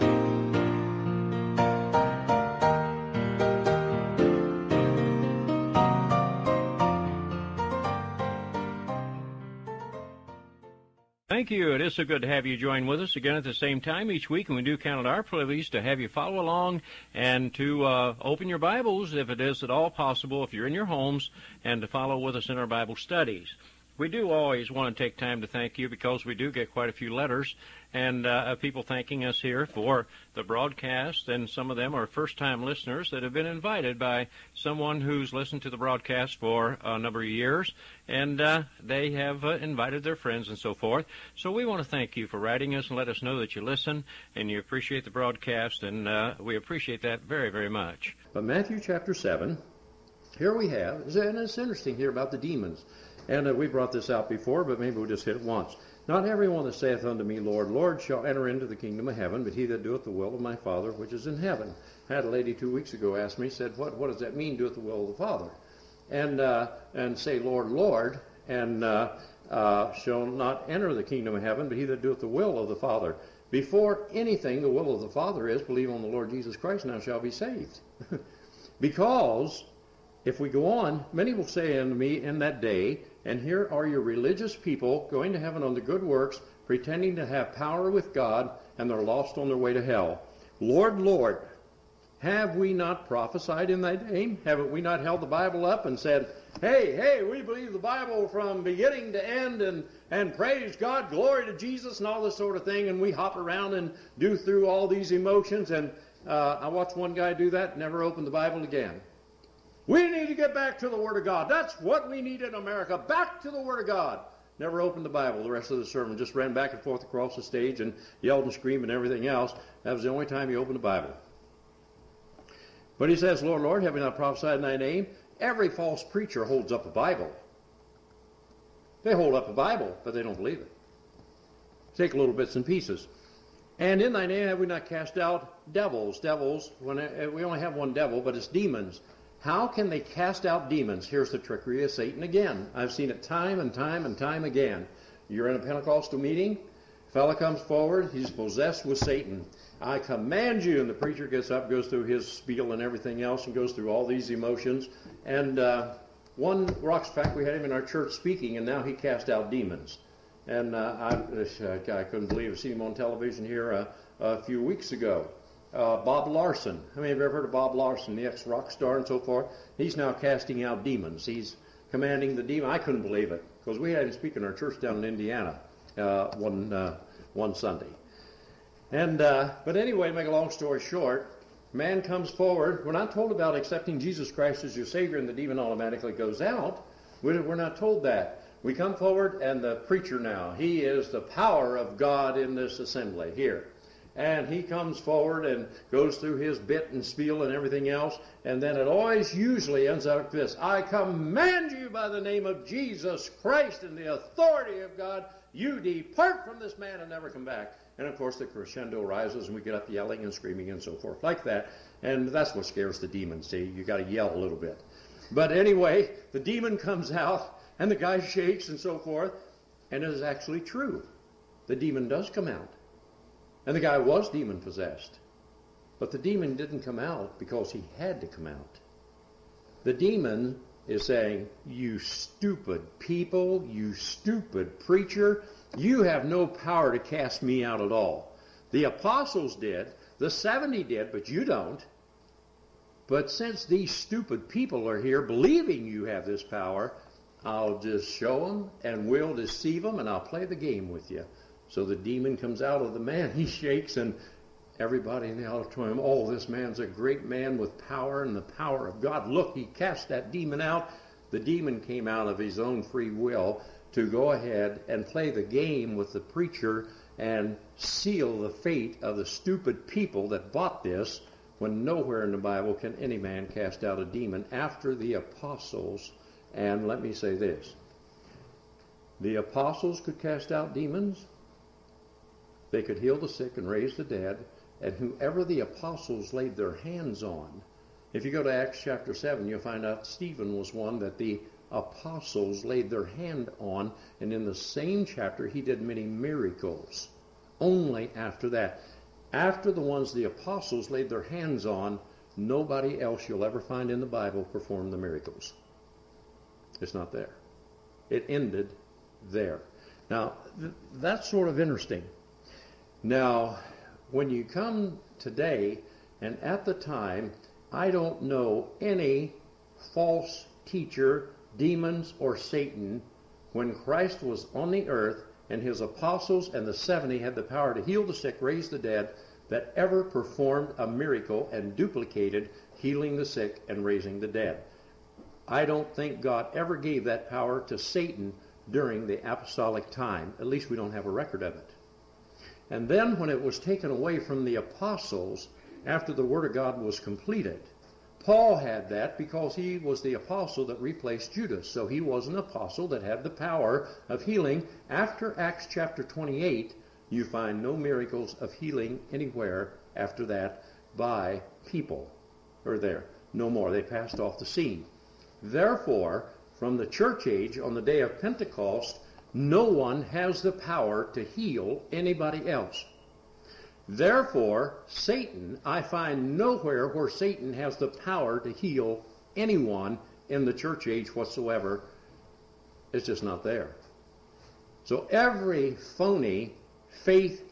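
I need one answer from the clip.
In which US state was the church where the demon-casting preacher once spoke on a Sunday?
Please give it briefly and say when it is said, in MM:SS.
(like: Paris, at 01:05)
Indiana, at 02:55.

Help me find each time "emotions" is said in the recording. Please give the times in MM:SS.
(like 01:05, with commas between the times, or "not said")
01:45, 02:34.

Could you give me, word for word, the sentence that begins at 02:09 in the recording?
They hold up a Bible, but they don't believe it.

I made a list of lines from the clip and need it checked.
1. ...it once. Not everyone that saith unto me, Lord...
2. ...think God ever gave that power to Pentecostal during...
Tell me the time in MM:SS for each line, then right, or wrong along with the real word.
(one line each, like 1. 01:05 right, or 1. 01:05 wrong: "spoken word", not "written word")
1. 00:55 right
2. 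05:35 wrong: "Satan", not "Pentecostal".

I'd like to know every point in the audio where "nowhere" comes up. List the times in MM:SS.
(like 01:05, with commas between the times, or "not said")
04:31, 06:16.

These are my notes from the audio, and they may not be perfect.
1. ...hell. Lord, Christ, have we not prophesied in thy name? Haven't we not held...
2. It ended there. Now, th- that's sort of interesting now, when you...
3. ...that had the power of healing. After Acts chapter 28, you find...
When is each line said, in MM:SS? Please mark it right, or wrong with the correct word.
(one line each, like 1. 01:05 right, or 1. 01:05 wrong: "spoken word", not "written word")
1. 01:29 wrong: "Lord", not "Christ"
2. 05:08 right
3. 05:52 right.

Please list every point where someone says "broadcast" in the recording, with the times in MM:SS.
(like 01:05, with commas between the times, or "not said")
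00:30, 00:35, 00:45.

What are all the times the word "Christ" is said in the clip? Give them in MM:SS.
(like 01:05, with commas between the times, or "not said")
01:16, 03:04, 03:23, 05:23.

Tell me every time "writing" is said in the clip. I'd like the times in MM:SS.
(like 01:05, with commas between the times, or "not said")
00:42.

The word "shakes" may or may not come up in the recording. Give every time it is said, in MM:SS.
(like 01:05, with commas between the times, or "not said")
03:38, 04:13.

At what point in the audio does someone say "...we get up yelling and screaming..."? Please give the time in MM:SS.
03:29.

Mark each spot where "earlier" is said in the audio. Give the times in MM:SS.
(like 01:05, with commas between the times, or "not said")
not said.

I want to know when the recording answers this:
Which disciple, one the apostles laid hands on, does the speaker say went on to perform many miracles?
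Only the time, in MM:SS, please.
04:50.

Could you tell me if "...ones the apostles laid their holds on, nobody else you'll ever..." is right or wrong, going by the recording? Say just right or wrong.
wrong.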